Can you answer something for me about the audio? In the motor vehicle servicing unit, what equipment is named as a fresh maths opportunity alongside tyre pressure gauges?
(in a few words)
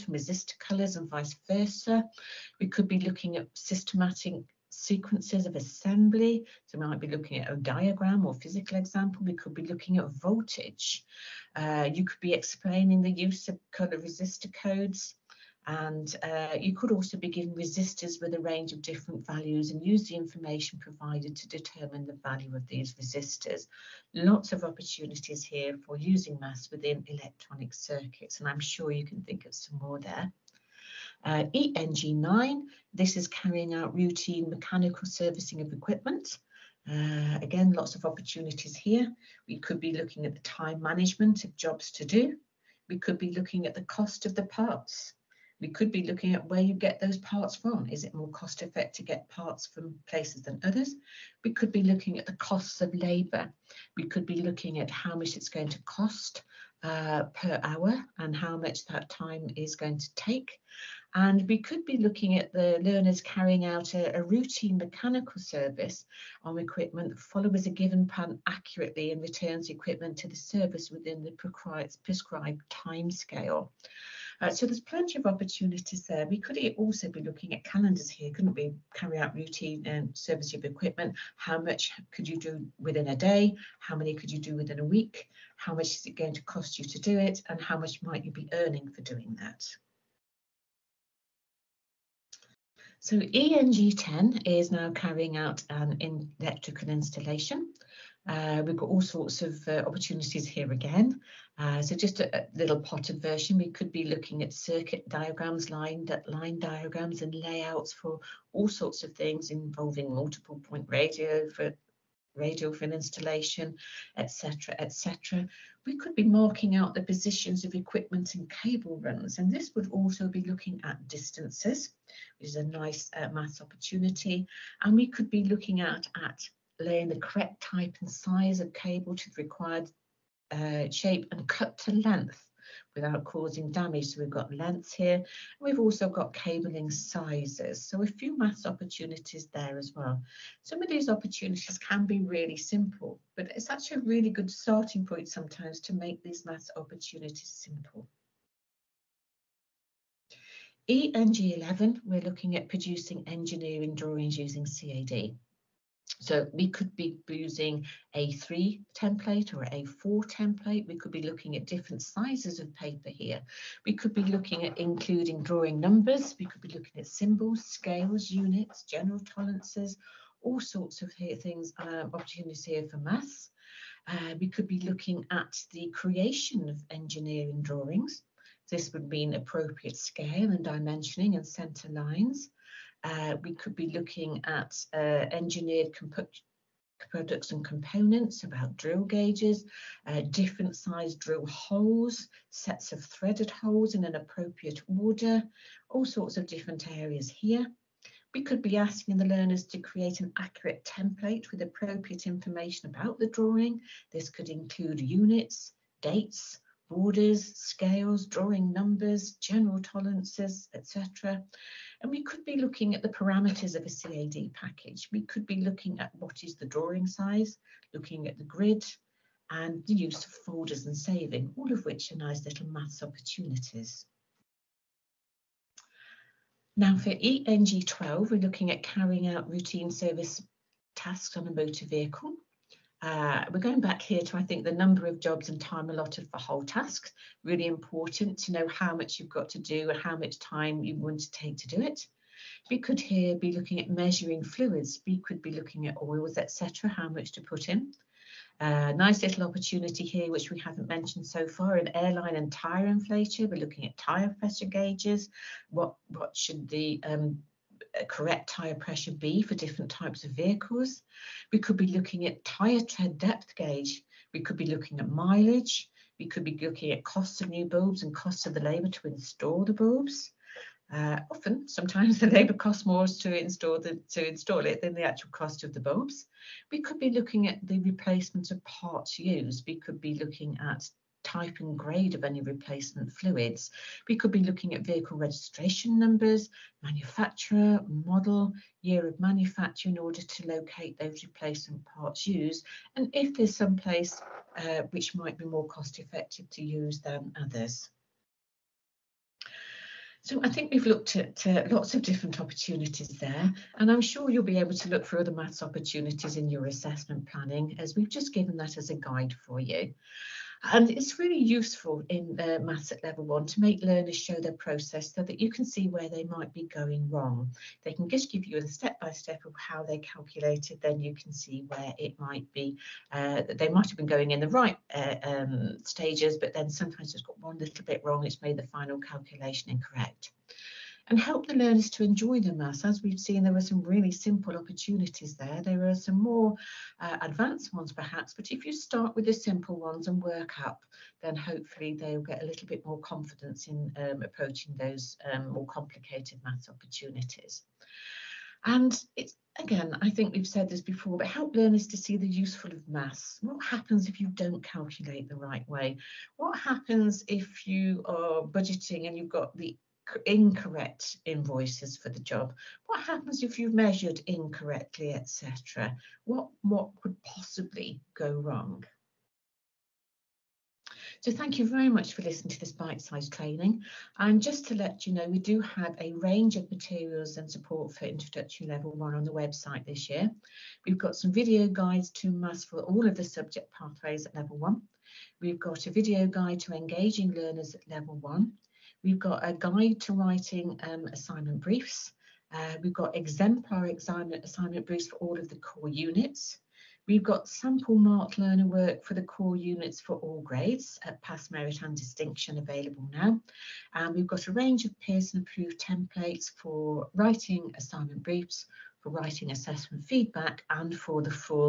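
Airline and tyre inflator.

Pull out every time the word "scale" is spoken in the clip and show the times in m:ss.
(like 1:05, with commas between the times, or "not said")
1:13, 2:47, 2:59, 3:27.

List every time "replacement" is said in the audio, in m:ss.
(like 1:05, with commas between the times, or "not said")
4:37, 4:42, 4:51.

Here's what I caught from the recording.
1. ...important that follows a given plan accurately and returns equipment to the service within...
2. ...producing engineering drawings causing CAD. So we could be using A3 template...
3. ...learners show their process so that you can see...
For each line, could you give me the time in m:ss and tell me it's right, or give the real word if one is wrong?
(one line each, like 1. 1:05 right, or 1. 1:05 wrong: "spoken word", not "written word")
1. 1:06 wrong: "equipment", not "important"
2. 2:32 wrong: "using", not "causing"
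3. 5:13 right.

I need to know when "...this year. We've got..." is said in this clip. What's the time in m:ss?
6:19.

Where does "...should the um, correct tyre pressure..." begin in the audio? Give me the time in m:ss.
4:16.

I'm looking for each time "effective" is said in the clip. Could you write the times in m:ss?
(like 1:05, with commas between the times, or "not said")
0:48, 4:55.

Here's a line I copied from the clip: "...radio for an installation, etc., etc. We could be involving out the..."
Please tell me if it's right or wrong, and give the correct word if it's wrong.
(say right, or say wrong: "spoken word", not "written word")
wrong: "marking", not "involving".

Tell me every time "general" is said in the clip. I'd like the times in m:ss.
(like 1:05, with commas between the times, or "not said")
2:48, 3:29.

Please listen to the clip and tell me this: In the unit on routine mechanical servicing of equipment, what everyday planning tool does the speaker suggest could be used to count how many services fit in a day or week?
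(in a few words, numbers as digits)
Calendars.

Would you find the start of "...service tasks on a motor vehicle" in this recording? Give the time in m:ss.
3:49.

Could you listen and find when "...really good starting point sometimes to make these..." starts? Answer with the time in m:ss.
2:24.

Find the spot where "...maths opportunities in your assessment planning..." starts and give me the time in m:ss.
5:05.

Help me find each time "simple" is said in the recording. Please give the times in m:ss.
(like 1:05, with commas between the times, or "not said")
2:22, 2:27, 5:34, 5:39.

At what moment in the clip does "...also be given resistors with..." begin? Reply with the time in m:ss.
0:16.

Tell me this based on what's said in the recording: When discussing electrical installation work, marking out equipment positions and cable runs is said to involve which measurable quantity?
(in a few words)
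Distances.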